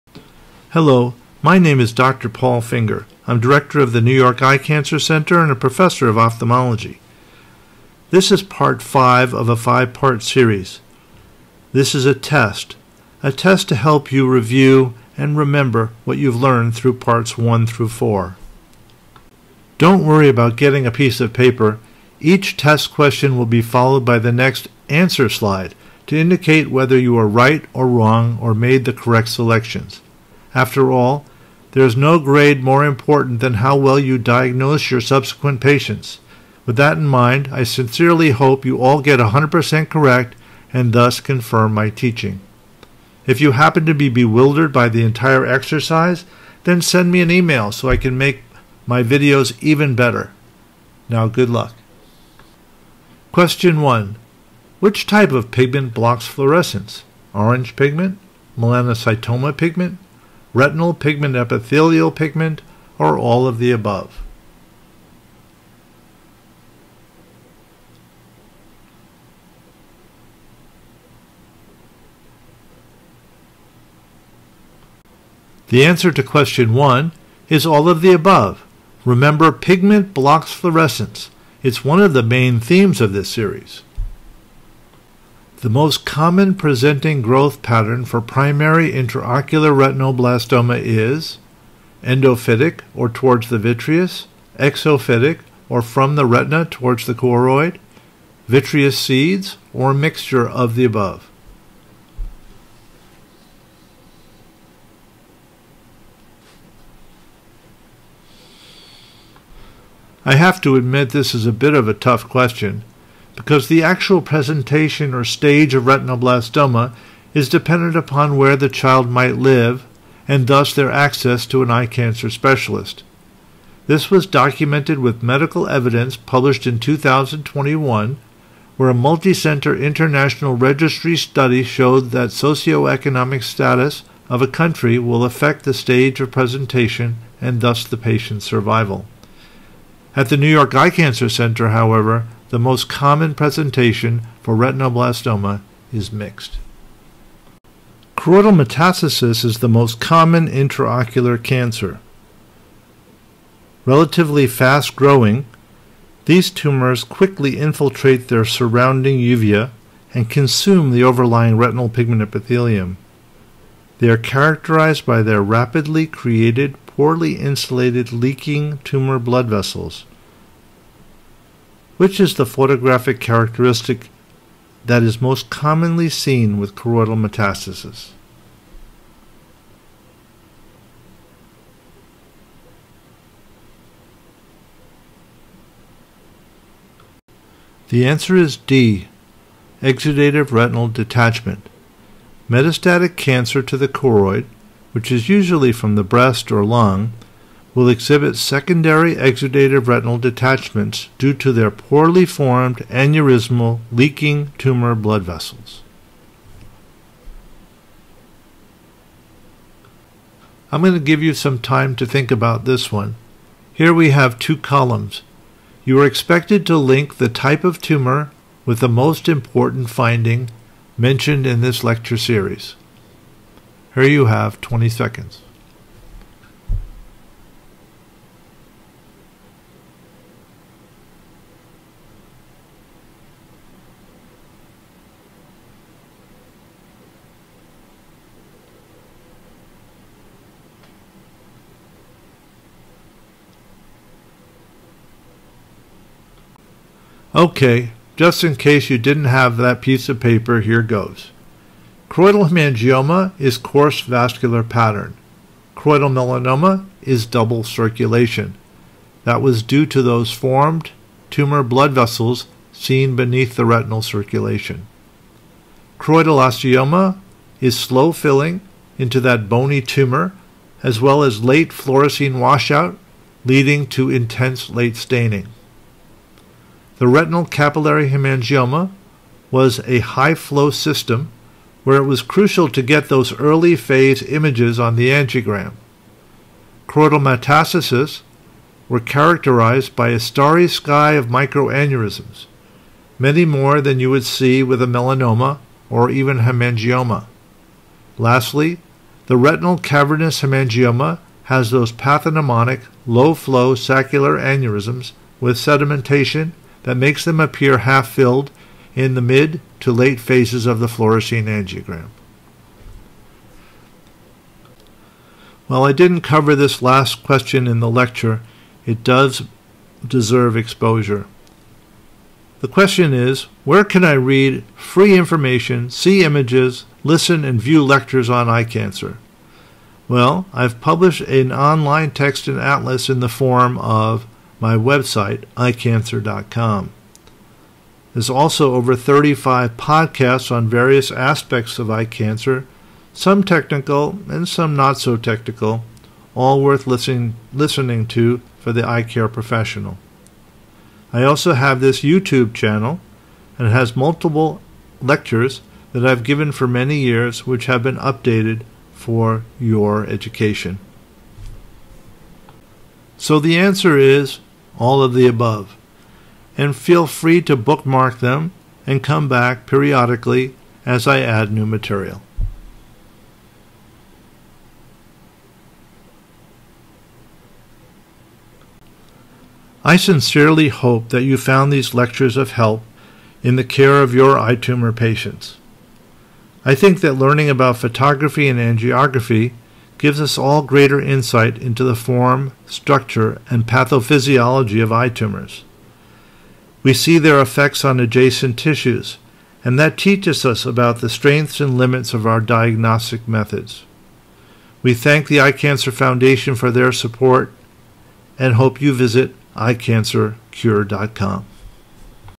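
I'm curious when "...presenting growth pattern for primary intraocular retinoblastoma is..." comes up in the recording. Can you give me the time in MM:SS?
01:26.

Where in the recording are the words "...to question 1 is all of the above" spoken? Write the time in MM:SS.
01:16.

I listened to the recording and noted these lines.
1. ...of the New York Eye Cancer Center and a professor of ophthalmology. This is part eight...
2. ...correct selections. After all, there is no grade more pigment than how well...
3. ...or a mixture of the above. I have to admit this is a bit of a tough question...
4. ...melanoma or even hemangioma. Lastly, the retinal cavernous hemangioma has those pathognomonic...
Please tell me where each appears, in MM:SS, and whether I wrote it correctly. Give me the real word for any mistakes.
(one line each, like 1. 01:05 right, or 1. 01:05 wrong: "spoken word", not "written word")
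1. 00:03 wrong: "five", not "eight"
2. 00:28 wrong: "important", not "pigment"
3. 01:39 right
4. 04:54 right.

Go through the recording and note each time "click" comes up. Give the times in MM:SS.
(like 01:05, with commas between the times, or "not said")
not said.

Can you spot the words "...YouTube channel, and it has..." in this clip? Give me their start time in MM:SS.
05:52.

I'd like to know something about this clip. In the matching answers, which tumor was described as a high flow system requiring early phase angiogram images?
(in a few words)
Retinal capillary hemangioma.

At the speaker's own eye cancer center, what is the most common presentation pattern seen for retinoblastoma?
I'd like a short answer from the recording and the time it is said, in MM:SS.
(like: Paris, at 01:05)
Mixed, at 02:26.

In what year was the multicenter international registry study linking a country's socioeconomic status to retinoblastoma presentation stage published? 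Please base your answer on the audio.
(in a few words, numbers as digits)
2021.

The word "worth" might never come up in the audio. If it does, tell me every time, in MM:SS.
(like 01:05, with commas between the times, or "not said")
05:46.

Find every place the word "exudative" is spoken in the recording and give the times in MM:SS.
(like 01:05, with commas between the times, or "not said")
03:09, 03:19.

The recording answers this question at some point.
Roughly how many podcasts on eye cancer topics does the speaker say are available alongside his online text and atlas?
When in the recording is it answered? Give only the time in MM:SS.
05:38.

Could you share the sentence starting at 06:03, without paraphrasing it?
So the answer is all of the above.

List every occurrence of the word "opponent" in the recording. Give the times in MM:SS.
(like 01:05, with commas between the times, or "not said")
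not said.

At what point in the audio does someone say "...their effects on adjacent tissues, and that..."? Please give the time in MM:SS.
06:37.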